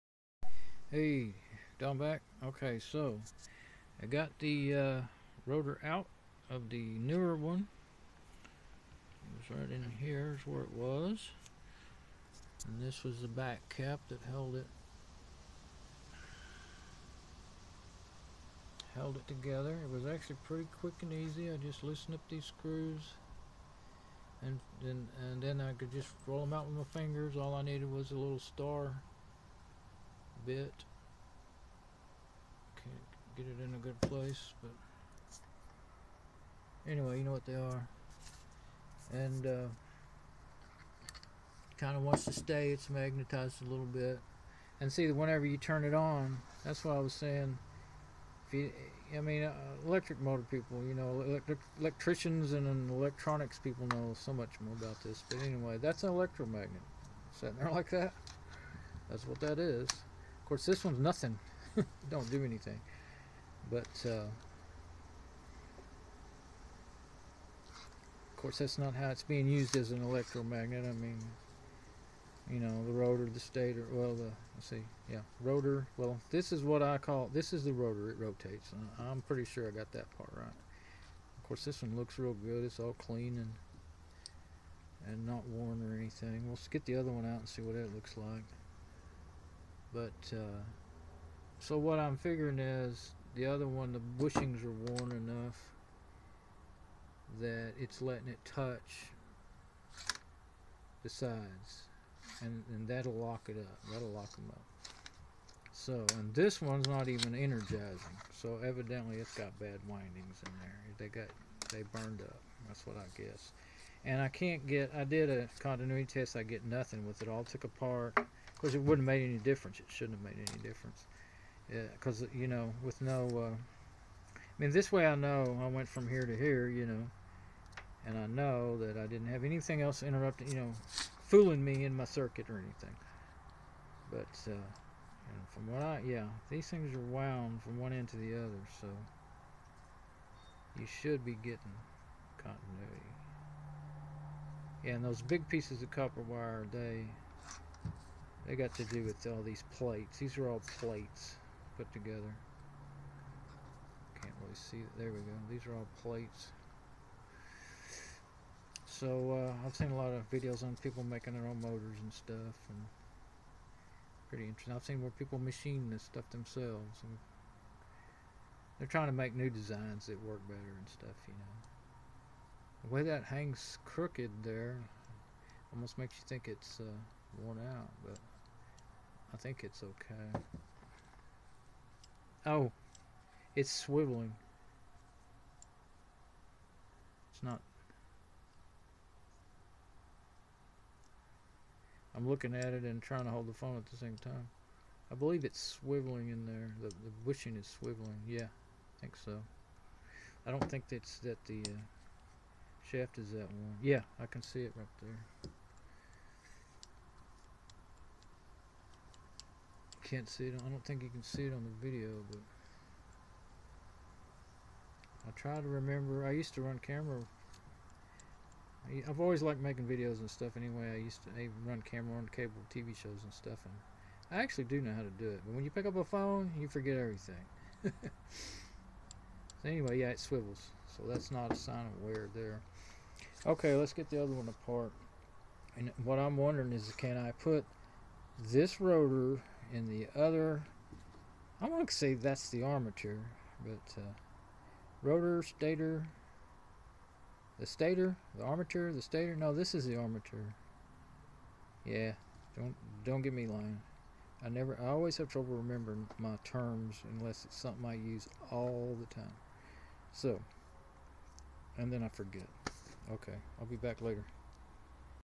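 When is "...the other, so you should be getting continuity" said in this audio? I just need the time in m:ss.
2:18.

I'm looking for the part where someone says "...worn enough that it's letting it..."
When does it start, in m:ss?
1:34.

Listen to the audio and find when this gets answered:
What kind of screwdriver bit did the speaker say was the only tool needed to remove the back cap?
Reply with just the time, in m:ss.
0:28.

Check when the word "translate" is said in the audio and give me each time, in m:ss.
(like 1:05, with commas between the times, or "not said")
not said.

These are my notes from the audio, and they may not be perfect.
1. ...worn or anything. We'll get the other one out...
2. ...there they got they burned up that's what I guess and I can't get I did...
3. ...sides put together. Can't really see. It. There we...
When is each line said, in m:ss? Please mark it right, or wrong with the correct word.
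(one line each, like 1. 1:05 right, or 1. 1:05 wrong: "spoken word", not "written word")
1. 1:25 right
2. 1:50 right
3. 2:30 wrong: "plates", not "sides".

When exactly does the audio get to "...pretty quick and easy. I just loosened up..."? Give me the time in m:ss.
0:20.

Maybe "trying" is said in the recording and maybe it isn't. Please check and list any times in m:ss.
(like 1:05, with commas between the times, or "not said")
2:48, 3:13.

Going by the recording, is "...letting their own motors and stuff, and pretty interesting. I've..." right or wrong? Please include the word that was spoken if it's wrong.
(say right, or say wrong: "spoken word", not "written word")
wrong: "making", not "letting".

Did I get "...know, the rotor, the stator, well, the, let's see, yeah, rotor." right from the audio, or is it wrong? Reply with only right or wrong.
right.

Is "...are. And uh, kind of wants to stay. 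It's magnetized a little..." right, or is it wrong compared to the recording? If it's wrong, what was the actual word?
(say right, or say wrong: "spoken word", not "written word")
right.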